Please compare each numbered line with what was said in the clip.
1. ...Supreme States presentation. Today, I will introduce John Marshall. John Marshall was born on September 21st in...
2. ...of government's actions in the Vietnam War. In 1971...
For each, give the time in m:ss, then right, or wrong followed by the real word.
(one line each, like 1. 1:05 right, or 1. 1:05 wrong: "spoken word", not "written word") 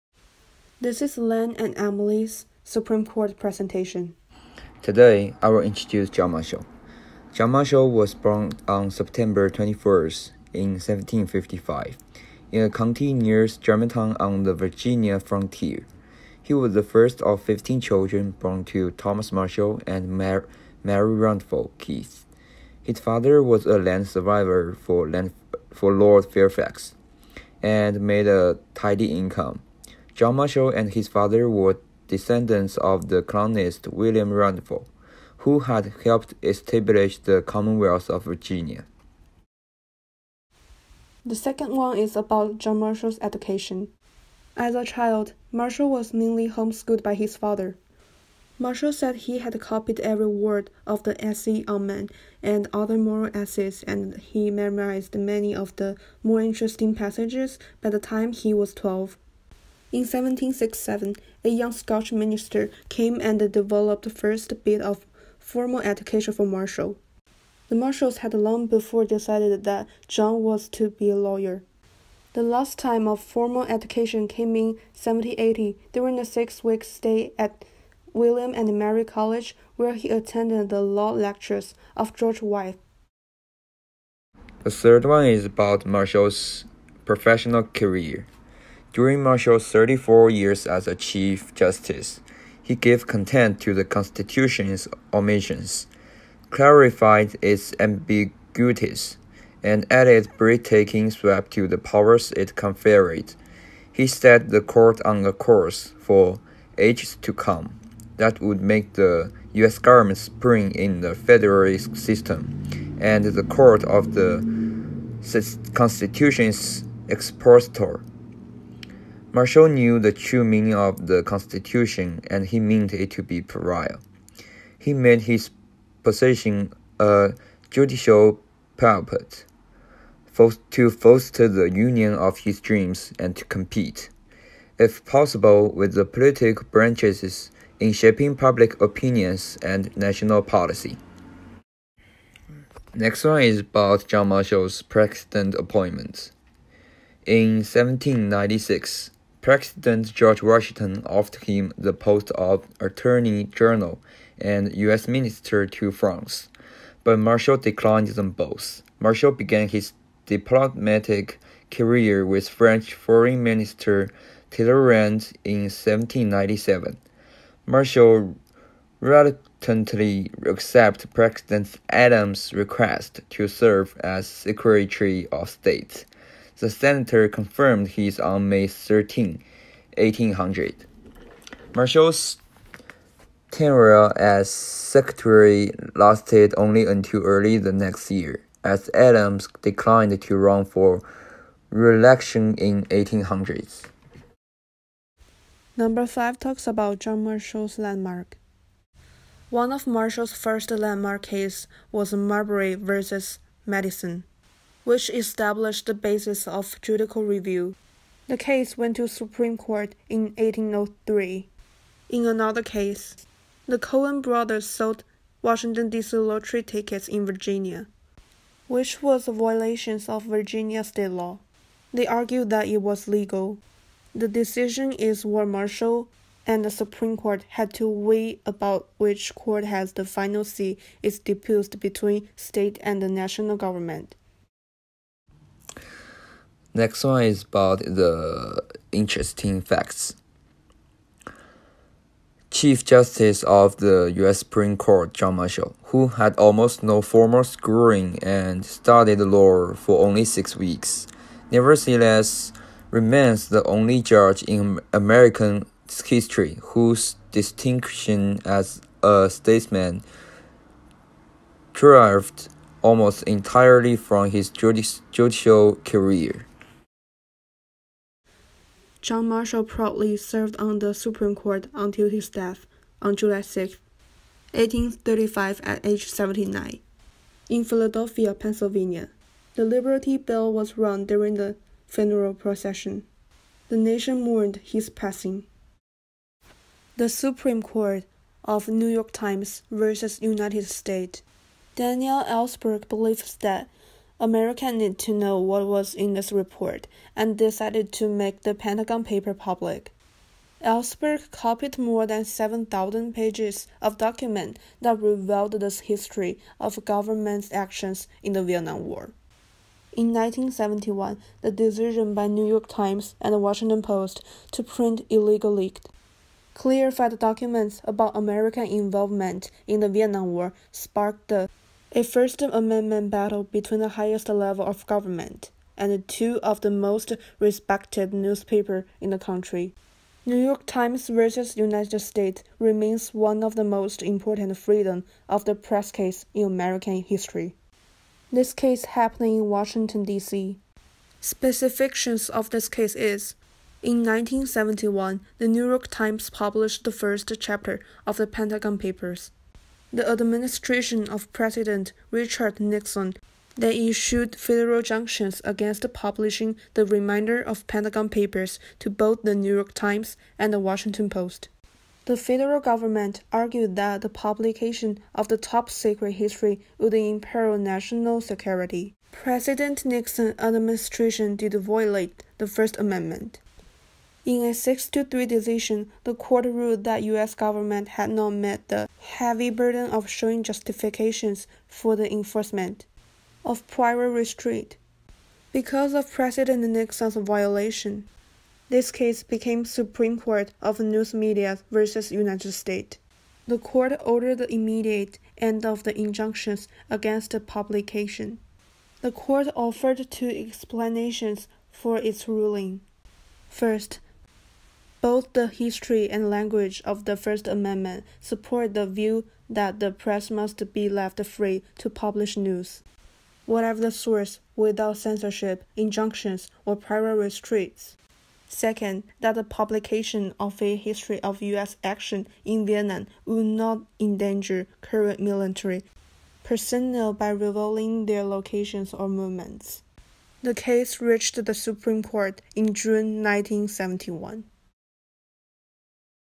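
1. 0:02 wrong: "Court", not "States"
2. 5:06 right.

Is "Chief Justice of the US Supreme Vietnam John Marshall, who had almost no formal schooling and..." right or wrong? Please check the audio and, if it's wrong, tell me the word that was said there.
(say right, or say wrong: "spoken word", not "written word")
wrong: "Court", not "Vietnam".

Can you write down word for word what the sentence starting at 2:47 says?
Marshall reluctantly accepted President Adams' request to serve as Secretary of State.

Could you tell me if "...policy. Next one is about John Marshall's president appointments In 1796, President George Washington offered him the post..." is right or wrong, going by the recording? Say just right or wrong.
right.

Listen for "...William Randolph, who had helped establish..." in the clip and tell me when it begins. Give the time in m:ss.
0:33.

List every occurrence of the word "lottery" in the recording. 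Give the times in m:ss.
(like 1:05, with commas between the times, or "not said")
3:36.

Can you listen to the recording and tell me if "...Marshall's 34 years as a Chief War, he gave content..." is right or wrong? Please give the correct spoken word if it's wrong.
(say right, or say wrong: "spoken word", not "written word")
wrong: "Justice", not "War".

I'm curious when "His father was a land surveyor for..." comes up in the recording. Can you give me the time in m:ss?
0:22.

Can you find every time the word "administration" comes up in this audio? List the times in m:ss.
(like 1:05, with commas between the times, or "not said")
5:50, 6:10.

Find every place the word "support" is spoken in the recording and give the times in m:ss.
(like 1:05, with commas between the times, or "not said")
6:48.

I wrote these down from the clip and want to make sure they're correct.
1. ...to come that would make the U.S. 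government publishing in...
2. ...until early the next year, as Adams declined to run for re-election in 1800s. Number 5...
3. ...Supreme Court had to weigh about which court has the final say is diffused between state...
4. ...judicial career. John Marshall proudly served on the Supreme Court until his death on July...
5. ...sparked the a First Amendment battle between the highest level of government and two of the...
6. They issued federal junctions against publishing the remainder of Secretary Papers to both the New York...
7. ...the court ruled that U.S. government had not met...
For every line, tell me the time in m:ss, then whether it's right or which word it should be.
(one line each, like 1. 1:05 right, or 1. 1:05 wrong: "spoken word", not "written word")
1. 1:47 wrong: "spring", not "publishing"
2. 3:06 right
3. 3:46 right
4. 4:24 right
5. 5:20 right
6. 5:53 wrong: "Pentagon", not "Secretary"
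7. 6:16 right.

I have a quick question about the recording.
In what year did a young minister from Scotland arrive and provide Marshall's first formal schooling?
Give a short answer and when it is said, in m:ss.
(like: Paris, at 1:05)
1767, at 1:00.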